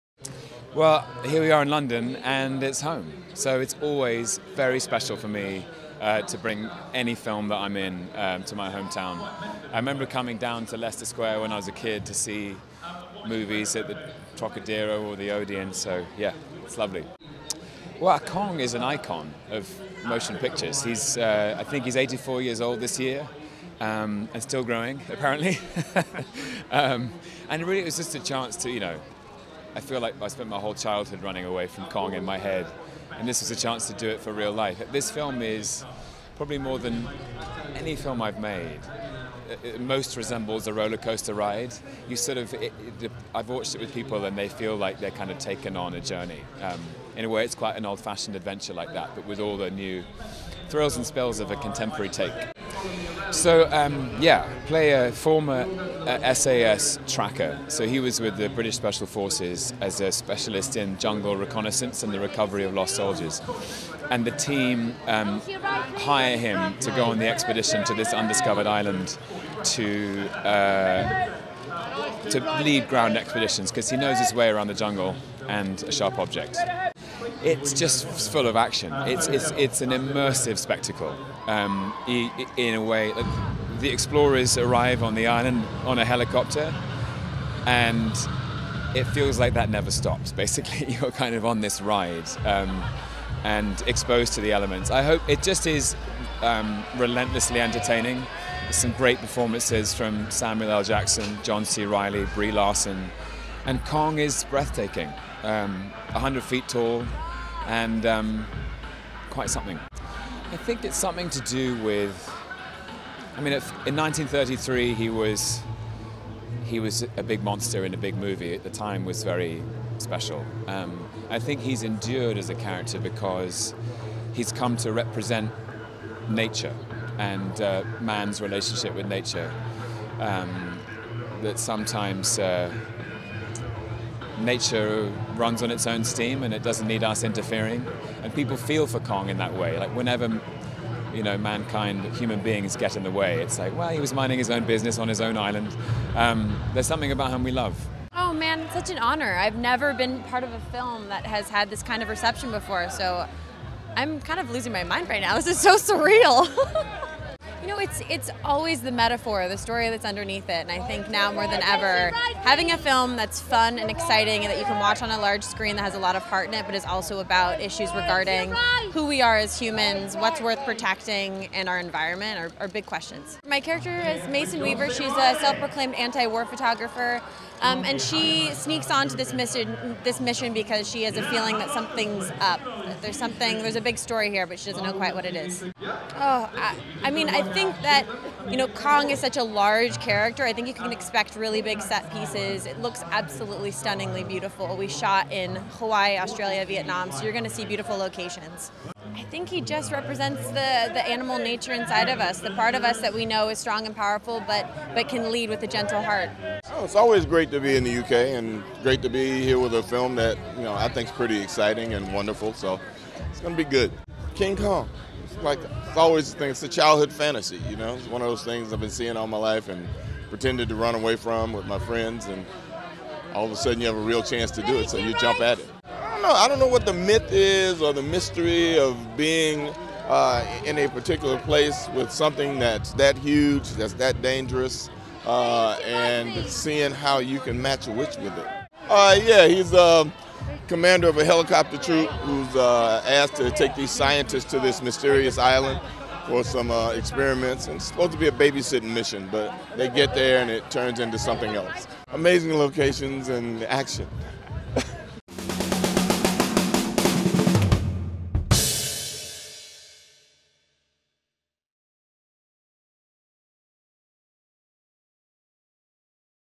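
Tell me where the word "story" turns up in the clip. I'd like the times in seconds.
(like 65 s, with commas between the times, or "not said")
159 s, 183 s.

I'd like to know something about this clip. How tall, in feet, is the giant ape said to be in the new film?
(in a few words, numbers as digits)
100.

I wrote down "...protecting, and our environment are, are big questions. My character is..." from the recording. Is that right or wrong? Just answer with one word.
right.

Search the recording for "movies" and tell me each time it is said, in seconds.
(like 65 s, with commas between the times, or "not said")
13 s, 118 s.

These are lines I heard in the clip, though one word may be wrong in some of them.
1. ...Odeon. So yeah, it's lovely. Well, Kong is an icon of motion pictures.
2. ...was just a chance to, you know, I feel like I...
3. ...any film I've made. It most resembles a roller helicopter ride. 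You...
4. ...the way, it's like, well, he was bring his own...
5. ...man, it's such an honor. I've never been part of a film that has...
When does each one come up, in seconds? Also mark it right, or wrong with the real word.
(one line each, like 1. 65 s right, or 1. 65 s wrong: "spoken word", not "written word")
1. 15 s right
2. 27 s right
3. 37 s wrong: "coaster", not "helicopter"
4. 143 s wrong: "minding", not "bring"
5. 148 s right.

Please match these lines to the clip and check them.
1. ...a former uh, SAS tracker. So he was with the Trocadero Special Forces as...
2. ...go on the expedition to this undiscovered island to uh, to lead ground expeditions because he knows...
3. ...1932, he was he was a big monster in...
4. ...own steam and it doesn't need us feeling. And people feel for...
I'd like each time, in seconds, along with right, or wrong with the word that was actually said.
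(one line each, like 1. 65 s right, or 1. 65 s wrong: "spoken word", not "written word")
1. 54 s wrong: "British", not "Trocadero"
2. 66 s right
3. 113 s wrong: "1933", not "1932"
4. 135 s wrong: "interfering", not "feeling".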